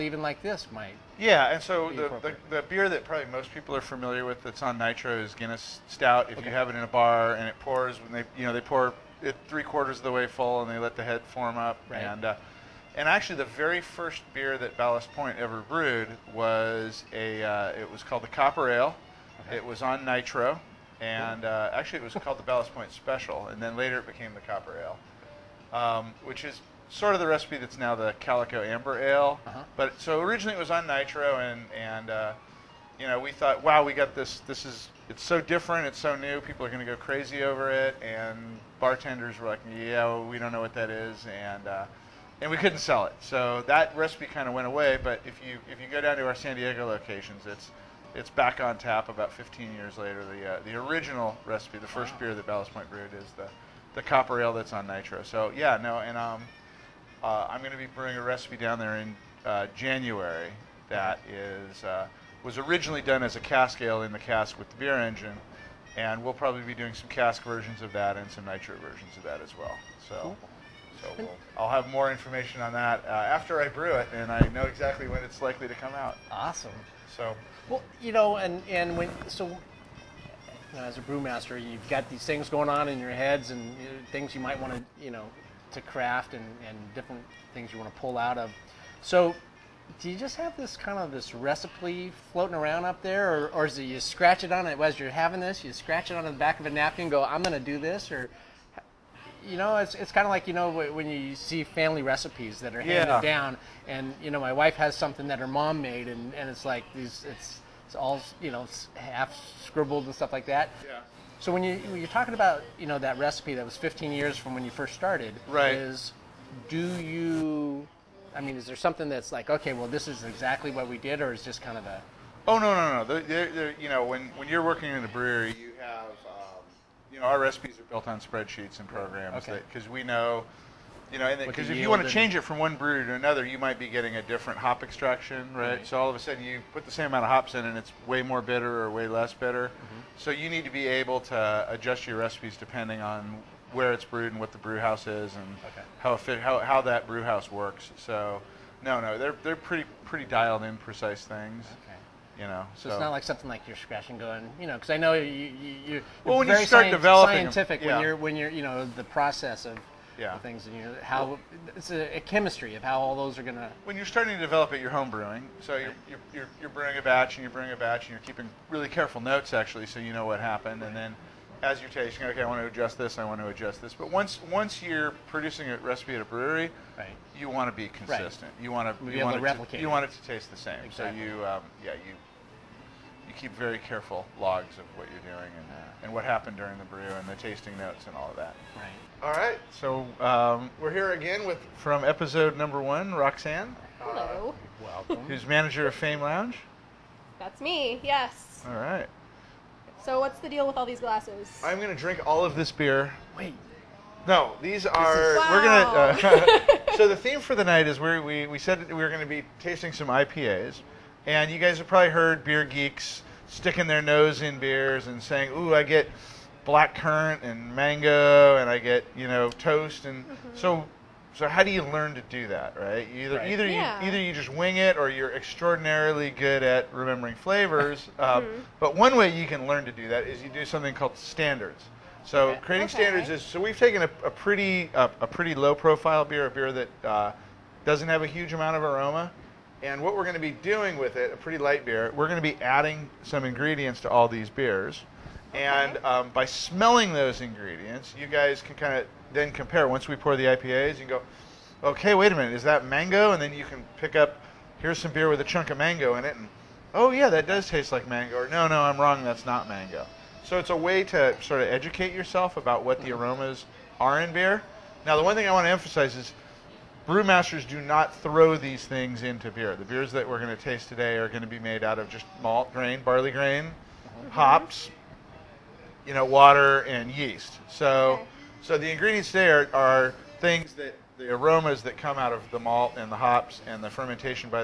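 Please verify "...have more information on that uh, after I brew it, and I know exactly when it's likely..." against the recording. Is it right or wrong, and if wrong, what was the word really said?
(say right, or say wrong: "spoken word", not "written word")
right.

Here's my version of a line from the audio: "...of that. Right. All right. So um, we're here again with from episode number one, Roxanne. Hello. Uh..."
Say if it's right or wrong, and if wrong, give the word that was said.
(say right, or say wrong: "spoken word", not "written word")
right.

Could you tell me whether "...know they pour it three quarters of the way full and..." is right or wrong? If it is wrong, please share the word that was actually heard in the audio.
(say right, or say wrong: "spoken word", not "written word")
right.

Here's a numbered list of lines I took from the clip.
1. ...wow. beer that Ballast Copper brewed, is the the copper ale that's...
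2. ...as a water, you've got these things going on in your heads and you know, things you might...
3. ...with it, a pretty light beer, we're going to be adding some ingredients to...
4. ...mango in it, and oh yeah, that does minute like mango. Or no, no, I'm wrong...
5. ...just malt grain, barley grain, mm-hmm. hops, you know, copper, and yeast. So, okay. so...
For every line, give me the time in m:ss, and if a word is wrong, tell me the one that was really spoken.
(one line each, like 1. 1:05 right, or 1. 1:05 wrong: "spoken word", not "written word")
1. 0:52 wrong: "Point", not "Copper"
2. 1:20 wrong: "brewmaster", not "water"
3. 4:00 right
4. 4:15 wrong: "taste", not "minute"
5. 4:32 wrong: "water", not "copper".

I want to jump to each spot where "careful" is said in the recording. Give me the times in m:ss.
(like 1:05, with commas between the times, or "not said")
2:48, 3:03.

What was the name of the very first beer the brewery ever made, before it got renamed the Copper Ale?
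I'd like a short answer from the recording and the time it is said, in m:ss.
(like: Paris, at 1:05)
Ballast Point Special, at 0:22.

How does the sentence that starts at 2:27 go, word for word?
So, no, no, they're they're pretty pretty dialed in precise things.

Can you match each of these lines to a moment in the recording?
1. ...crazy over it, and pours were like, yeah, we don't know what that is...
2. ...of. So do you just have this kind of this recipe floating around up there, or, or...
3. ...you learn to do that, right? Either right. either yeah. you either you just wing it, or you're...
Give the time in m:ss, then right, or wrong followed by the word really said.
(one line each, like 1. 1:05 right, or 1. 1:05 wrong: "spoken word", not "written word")
1. 0:36 wrong: "bartenders", not "pours"
2. 1:28 right
3. 3:41 right.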